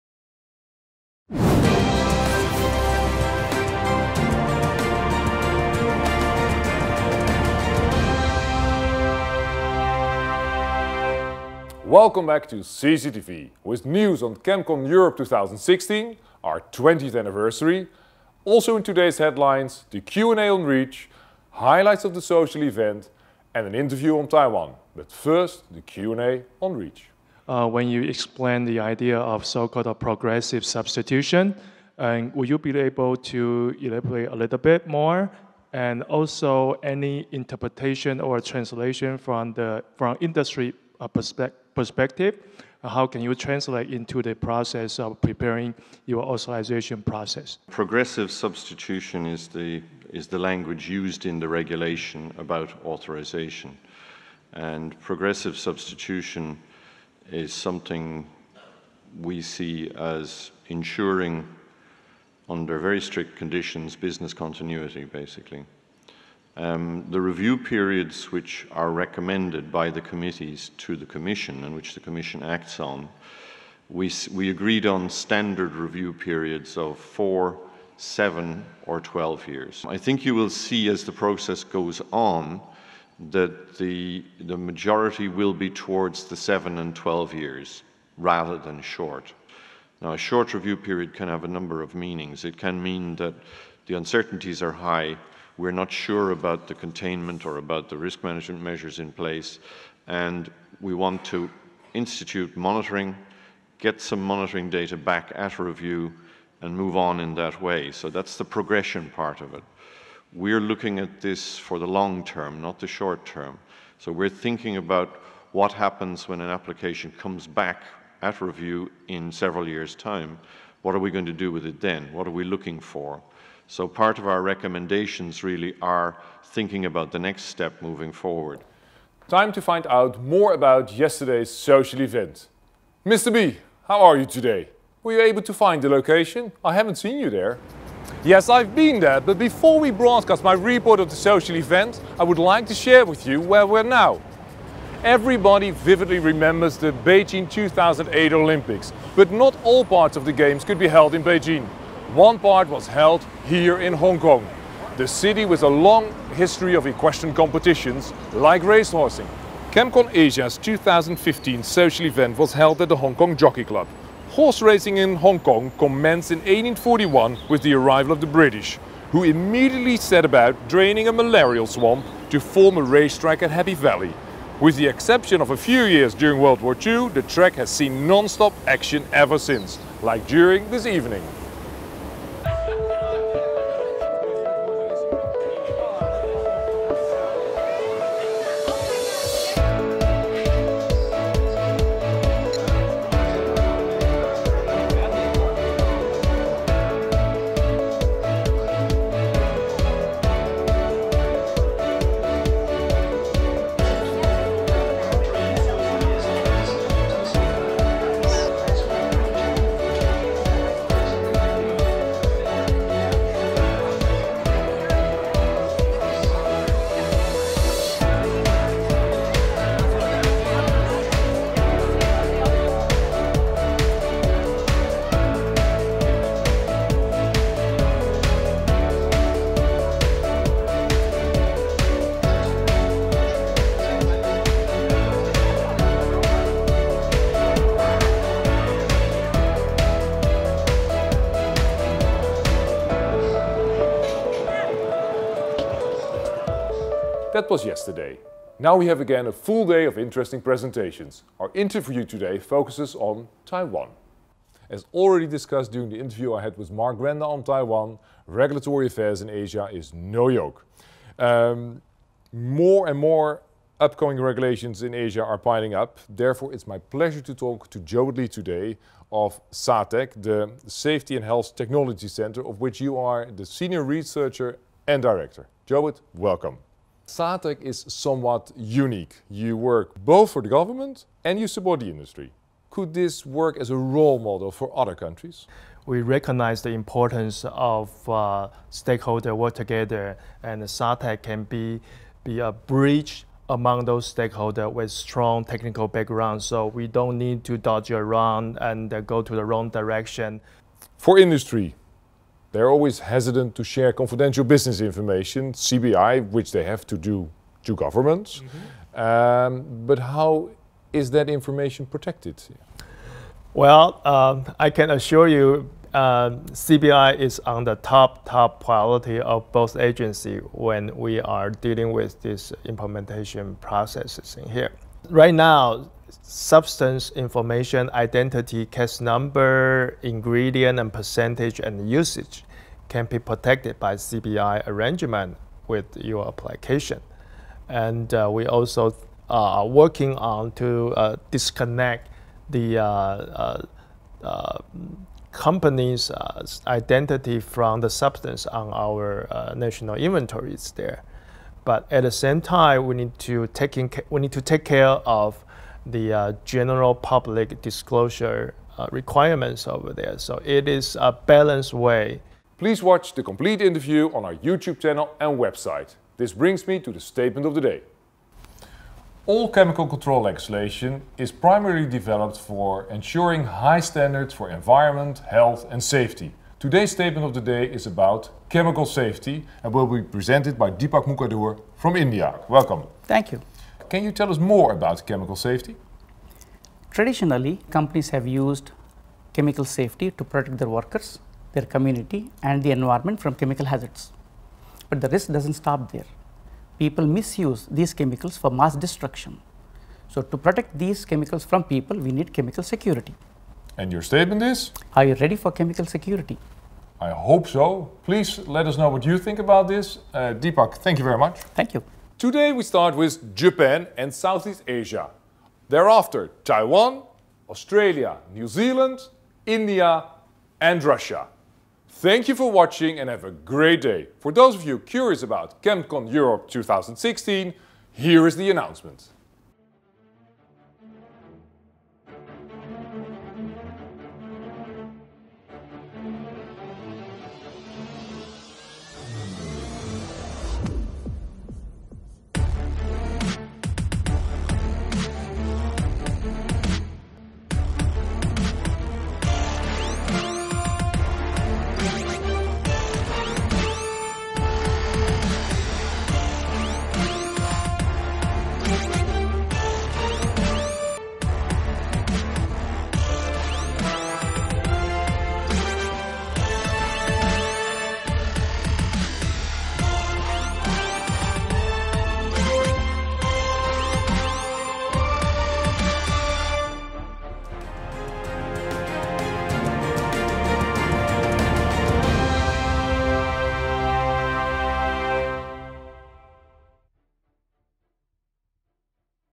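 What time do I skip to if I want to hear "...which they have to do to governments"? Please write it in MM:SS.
05:06.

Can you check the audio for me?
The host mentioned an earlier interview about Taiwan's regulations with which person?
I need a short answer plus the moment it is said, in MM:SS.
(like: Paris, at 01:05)
Mark Grenda, at 04:16.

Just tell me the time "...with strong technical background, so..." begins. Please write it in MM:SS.
04:54.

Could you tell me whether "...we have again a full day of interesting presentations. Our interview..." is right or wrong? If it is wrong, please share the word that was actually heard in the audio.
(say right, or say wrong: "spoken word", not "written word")
right.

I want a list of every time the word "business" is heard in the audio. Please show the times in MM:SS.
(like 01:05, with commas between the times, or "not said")
01:03, 05:04.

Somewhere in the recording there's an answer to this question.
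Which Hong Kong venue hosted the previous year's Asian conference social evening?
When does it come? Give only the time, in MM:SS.
02:42.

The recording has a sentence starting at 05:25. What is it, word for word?
Right now, substance information, identity, CAS number, ingredient, and percentage and usage can be protected by CBI arrangement with your application.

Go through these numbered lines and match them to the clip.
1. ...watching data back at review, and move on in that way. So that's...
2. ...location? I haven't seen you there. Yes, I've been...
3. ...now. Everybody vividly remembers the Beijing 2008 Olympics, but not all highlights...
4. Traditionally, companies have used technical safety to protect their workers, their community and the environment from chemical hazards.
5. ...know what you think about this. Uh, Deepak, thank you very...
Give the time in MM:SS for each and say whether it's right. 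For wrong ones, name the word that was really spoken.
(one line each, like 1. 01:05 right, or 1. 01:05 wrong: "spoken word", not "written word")
1. 01:44 wrong: "monitoring", not "watching"
2. 02:15 right
3. 02:23 wrong: "parts", not "highlights"
4. 06:26 wrong: "chemical", not "technical"
5. 06:48 right.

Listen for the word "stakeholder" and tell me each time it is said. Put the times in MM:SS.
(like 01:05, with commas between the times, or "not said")
04:48, 04:54.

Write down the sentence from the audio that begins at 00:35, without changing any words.
And also any interpretation or translation from the from industry uh, perspective?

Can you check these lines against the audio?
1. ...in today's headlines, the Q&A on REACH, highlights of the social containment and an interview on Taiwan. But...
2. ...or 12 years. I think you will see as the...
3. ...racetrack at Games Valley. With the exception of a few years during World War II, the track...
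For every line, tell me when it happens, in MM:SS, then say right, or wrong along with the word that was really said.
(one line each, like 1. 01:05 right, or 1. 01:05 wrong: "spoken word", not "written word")
1. 00:18 wrong: "event", not "containment"
2. 01:18 right
3. 02:52 wrong: "Happy", not "Games".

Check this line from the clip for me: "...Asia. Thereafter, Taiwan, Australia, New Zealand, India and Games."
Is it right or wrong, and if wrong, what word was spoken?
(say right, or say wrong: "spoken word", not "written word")
wrong: "Russia", not "Games".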